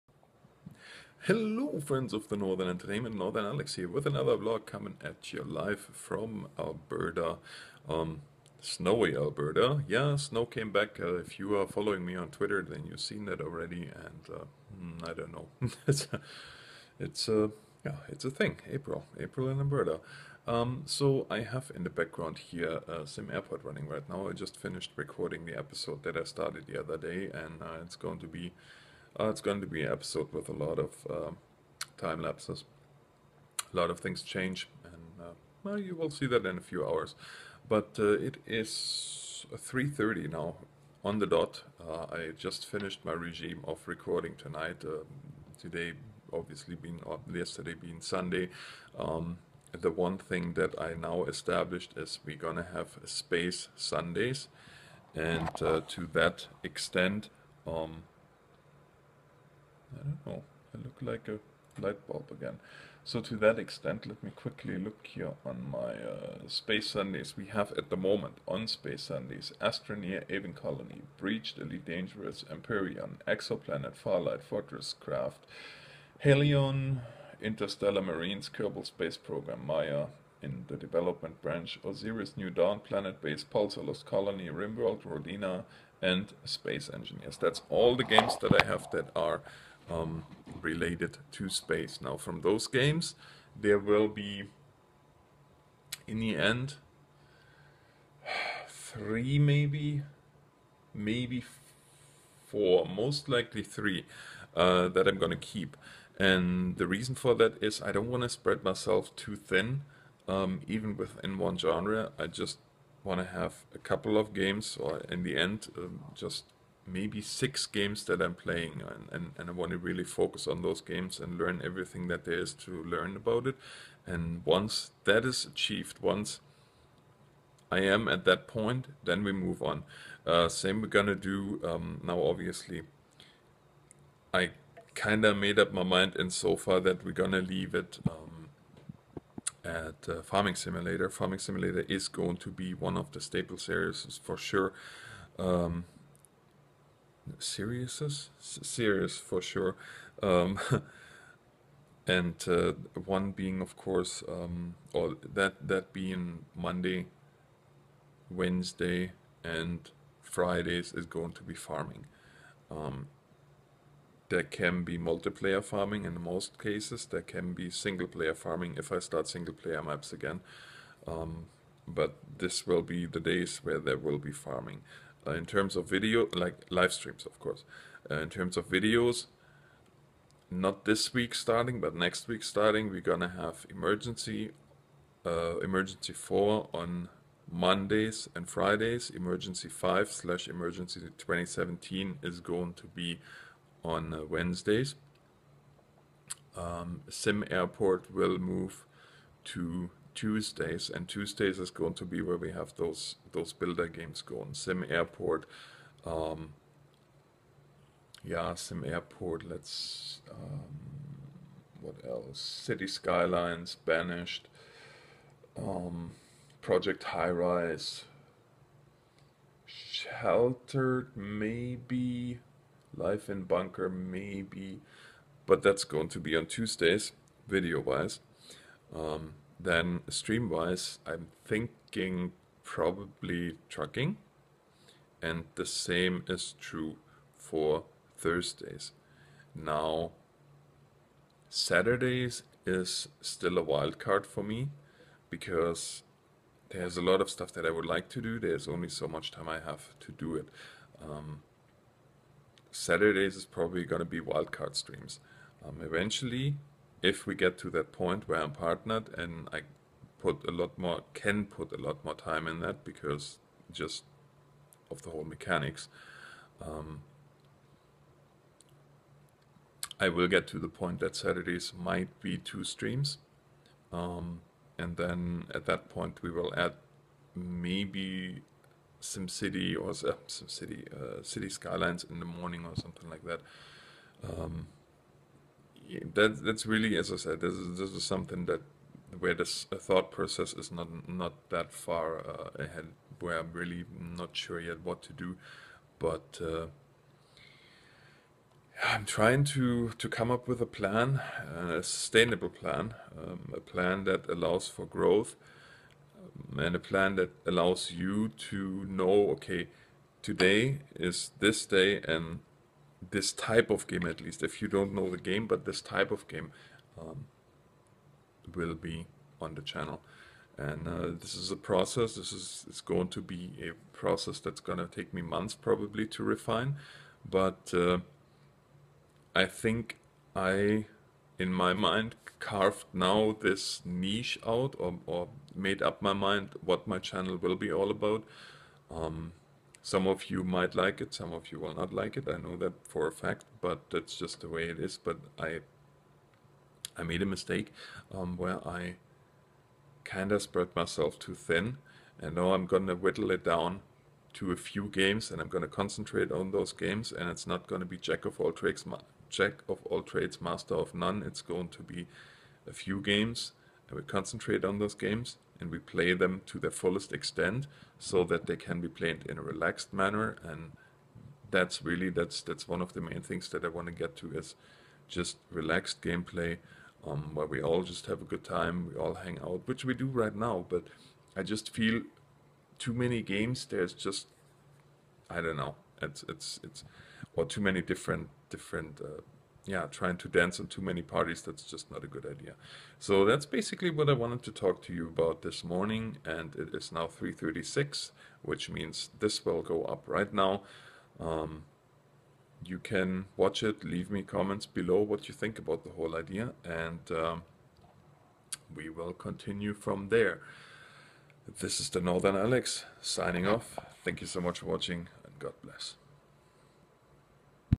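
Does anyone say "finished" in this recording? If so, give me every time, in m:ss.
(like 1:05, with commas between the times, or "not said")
0:24, 0:42.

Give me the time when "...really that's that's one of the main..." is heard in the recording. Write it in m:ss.
6:11.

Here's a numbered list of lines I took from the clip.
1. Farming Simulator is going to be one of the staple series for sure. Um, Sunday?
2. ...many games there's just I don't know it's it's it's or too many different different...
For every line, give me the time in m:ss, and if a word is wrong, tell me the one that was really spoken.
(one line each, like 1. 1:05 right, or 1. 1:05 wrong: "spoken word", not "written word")
1. 2:21 wrong: "Siriuses", not "Sunday"
2. 6:22 right.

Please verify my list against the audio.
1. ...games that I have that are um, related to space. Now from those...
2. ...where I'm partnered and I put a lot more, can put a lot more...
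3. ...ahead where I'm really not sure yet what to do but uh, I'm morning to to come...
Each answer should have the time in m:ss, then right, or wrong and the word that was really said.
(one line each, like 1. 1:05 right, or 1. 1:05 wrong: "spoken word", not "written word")
1. 1:28 right
2. 4:18 right
3. 4:52 wrong: "trying", not "morning".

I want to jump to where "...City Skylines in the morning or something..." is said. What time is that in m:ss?
4:41.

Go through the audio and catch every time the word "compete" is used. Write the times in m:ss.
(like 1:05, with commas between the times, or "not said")
not said.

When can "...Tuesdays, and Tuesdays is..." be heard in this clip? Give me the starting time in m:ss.
3:20.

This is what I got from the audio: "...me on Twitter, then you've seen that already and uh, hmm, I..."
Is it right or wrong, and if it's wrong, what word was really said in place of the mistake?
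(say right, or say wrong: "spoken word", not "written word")
right.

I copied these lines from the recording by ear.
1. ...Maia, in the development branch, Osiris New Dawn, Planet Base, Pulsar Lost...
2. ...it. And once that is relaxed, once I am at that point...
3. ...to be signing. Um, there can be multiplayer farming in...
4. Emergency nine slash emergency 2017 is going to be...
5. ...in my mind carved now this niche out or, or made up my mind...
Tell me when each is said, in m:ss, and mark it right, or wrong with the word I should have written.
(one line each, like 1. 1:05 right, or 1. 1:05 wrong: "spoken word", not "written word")
1. 1:19 right
2. 2:03 wrong: "achieved", not "relaxed"
3. 2:41 wrong: "farming", not "signing"
4. 3:09 wrong: "five", not "nine"
5. 5:31 right.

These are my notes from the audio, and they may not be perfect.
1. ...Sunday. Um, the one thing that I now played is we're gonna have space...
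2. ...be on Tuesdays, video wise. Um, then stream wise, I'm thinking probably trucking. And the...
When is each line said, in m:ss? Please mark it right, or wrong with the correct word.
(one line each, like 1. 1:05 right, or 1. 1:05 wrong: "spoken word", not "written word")
1. 0:48 wrong: "established", not "played"
2. 3:46 right.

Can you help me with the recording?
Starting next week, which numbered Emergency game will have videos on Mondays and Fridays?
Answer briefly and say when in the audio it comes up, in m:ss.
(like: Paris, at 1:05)
Emergency 4, at 3:05.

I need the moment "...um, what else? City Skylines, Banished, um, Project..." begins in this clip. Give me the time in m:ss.
3:30.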